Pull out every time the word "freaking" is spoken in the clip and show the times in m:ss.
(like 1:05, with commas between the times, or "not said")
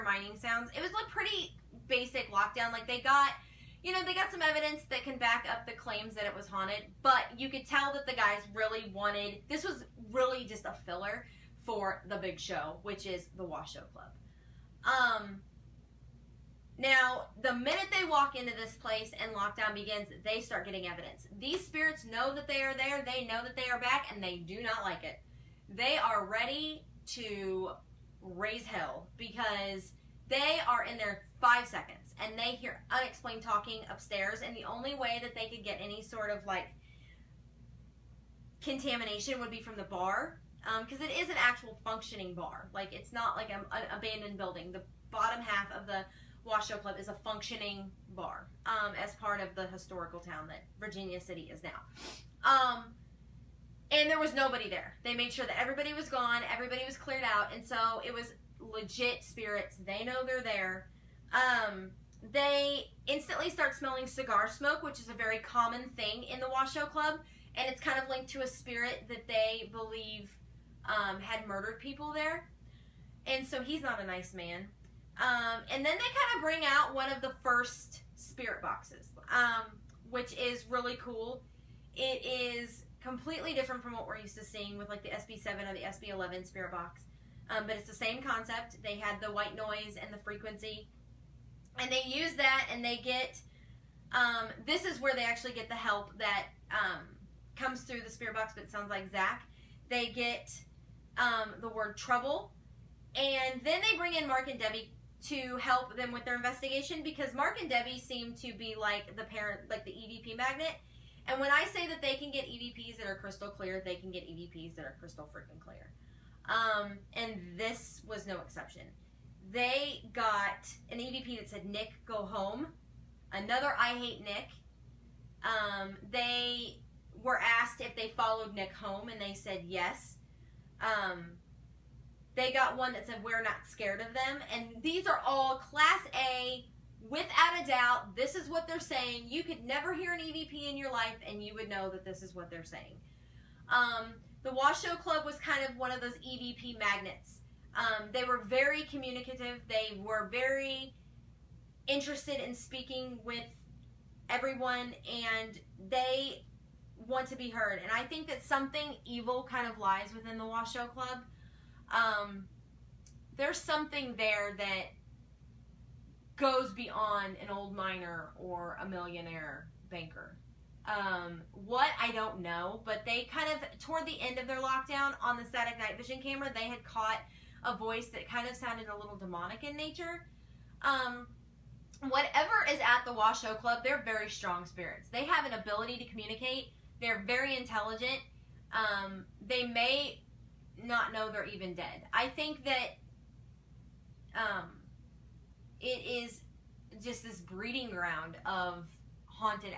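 1:55.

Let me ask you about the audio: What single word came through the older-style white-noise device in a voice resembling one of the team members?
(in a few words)
Trouble.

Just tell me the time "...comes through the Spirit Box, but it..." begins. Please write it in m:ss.
1:37.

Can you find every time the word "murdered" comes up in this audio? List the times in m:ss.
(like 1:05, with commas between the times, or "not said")
1:11.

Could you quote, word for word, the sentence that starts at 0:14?
Um, now, the minute they walk into this place and lockdown begins, they start getting evidence.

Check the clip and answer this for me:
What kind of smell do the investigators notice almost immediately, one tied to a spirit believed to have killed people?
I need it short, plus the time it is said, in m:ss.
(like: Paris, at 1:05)
Cigar smoke, at 1:04.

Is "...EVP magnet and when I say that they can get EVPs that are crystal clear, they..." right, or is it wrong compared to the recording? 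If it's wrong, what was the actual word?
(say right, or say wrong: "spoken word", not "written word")
right.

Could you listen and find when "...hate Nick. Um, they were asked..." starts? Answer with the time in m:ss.
2:03.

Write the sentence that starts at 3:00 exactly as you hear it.
Um, whatever is at the Washoe Club, they're very strong spirits.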